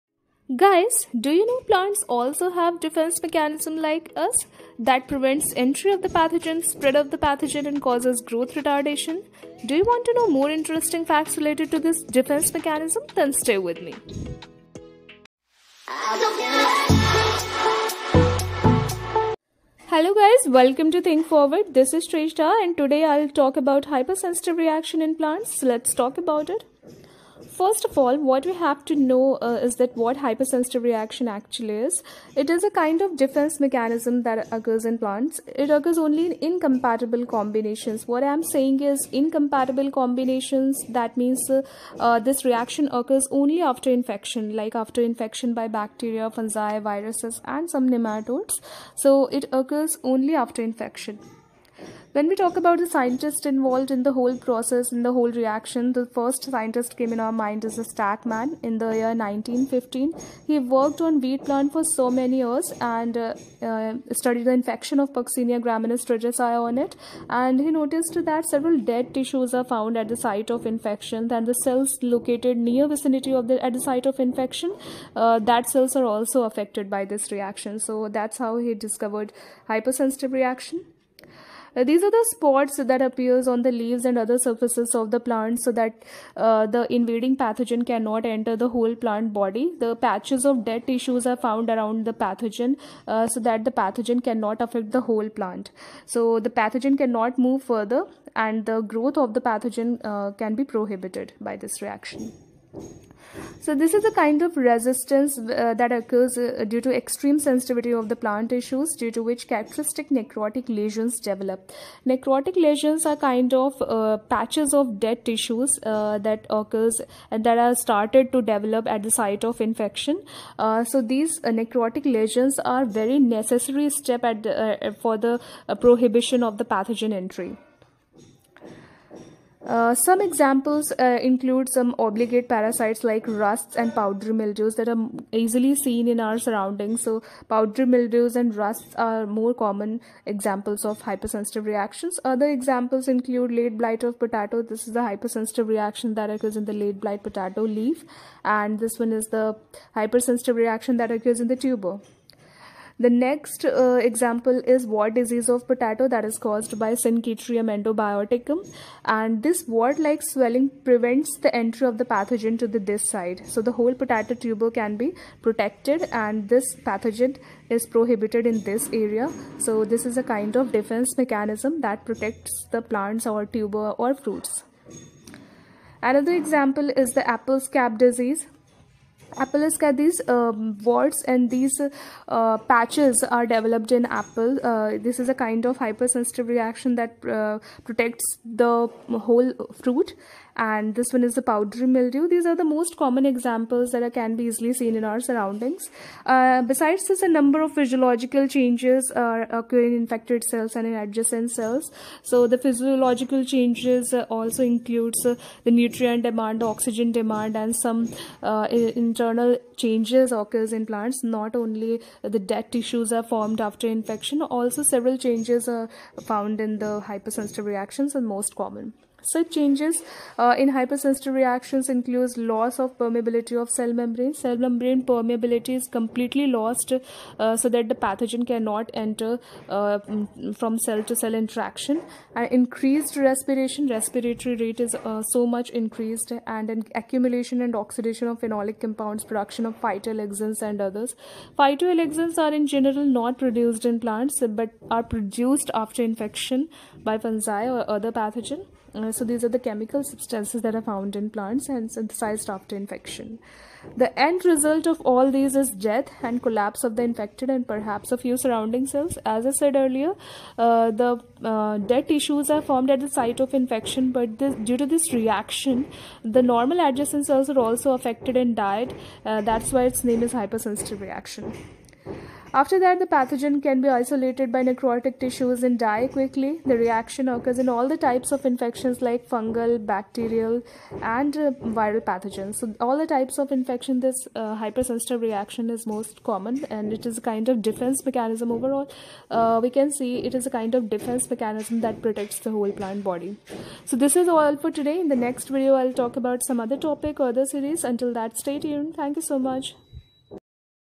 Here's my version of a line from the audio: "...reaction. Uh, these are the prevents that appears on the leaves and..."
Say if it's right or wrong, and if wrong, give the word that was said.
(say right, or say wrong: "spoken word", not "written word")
wrong: "spots", not "prevents".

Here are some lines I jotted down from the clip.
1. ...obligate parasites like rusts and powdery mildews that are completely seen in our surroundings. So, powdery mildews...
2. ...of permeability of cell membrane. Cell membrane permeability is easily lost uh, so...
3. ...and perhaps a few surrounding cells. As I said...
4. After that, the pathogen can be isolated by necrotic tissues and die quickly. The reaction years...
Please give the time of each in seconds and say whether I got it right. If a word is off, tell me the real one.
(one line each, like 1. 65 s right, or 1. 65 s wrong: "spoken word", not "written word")
1. 131 s wrong: "easily", not "completely"
2. 222 s wrong: "completely", not "easily"
3. 257 s right
4. 272 s wrong: "occurs", not "years".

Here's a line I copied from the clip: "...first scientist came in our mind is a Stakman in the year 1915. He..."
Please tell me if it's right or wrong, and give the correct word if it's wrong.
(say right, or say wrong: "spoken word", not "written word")
right.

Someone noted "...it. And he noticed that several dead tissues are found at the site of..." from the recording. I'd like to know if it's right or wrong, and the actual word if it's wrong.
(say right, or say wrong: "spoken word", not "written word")
right.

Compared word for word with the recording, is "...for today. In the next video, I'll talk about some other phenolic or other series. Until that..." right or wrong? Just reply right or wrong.
wrong.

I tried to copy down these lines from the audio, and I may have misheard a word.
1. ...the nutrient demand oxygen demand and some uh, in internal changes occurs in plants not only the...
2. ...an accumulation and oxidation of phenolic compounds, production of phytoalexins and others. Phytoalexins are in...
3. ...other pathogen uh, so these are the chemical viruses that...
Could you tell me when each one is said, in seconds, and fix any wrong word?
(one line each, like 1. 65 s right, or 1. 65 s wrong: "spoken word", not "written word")
1. 205 s right
2. 236 s right
3. 247 s wrong: "substances", not "viruses".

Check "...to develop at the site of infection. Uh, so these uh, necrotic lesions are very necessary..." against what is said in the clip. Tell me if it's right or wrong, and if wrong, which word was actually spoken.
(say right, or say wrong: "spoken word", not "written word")
right.